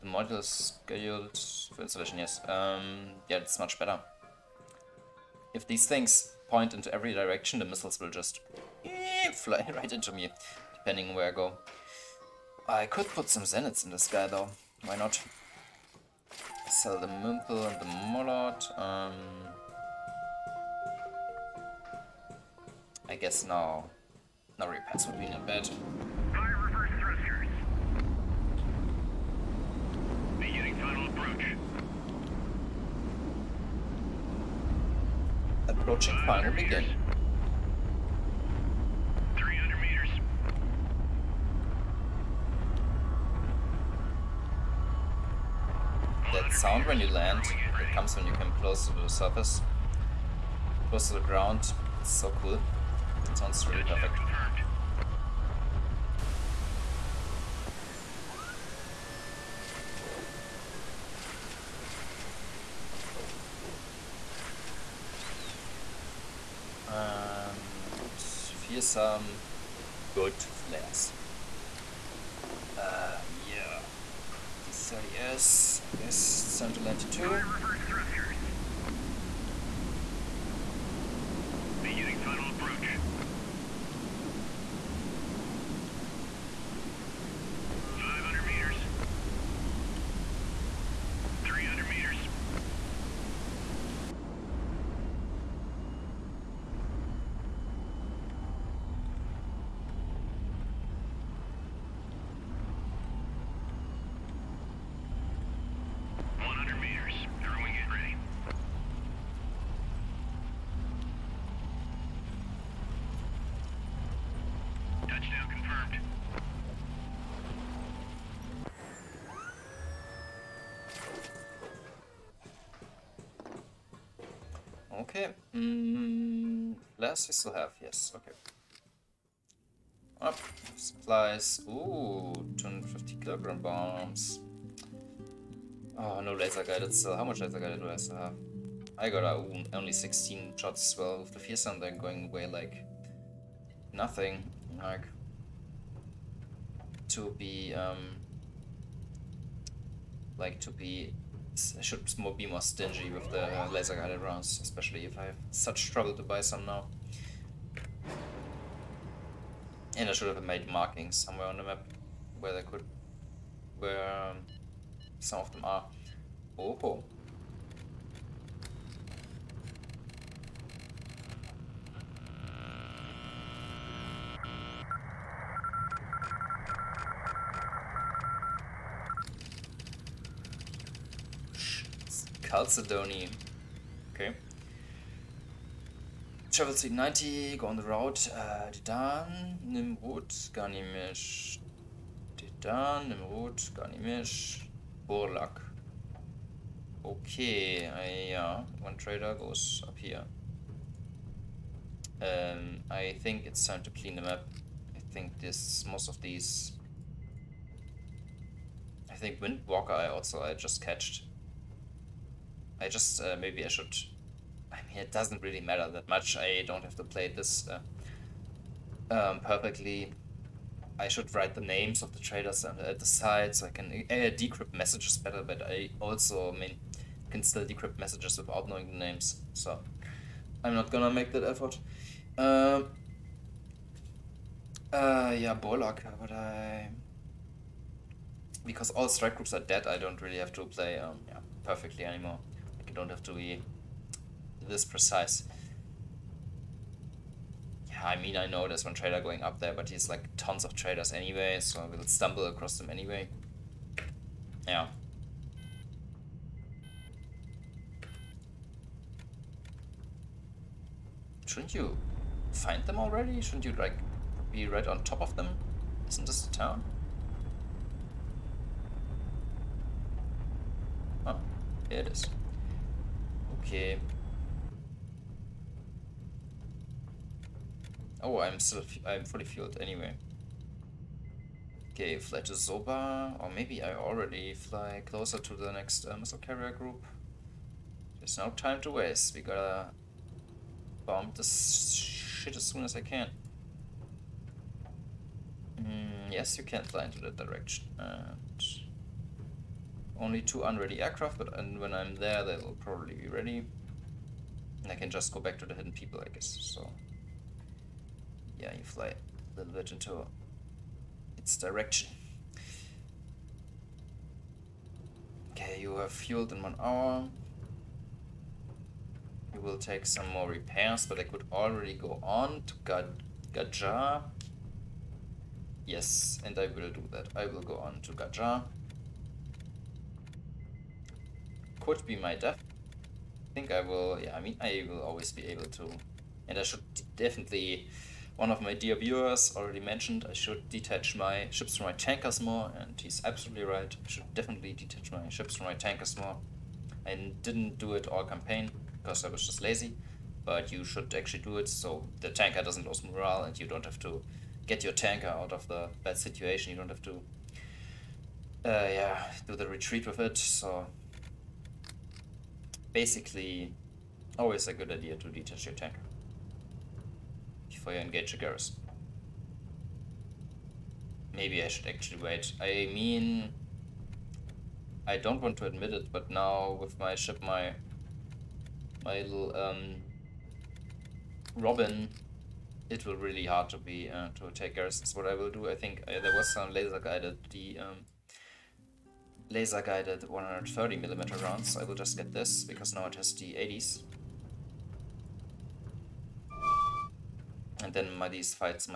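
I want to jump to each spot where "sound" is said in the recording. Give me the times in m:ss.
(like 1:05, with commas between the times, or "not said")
0:46, 0:53, 2:21.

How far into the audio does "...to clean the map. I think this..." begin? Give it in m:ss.
3:23.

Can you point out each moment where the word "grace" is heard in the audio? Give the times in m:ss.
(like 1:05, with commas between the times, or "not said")
not said.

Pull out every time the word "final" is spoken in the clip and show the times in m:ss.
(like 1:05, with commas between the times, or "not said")
0:30, 0:36.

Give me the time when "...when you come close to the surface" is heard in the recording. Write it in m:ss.
0:48.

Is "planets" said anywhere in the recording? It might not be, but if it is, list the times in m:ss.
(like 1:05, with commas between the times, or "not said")
not said.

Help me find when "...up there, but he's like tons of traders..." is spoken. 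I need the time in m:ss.
4:09.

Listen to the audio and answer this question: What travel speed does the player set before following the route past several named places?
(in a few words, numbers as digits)
90.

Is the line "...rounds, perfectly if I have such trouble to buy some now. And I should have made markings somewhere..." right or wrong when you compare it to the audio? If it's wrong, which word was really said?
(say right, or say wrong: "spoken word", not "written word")
wrong: "especially", not "perfectly".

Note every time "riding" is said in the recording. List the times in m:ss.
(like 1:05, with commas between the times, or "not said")
not said.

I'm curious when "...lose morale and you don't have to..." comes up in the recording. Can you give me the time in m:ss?
5:52.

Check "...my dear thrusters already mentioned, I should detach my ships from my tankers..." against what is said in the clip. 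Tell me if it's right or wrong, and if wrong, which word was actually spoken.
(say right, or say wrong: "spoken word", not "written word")
wrong: "viewers", not "thrusters".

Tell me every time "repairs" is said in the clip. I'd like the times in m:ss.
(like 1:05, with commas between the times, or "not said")
0:24, 5:20.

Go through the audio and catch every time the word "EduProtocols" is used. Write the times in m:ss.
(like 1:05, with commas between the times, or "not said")
not said.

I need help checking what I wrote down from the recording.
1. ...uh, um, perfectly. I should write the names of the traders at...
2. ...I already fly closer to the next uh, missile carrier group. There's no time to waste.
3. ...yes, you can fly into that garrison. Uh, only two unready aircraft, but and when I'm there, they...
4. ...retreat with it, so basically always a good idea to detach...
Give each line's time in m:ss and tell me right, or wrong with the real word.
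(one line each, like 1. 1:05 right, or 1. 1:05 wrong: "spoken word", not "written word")
1. 3:37 right
2. 4:43 right
3. 4:56 wrong: "direction", not "garrison"
4. 5:59 right.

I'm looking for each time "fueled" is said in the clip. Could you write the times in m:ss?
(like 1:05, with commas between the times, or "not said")
4:39, 5:16.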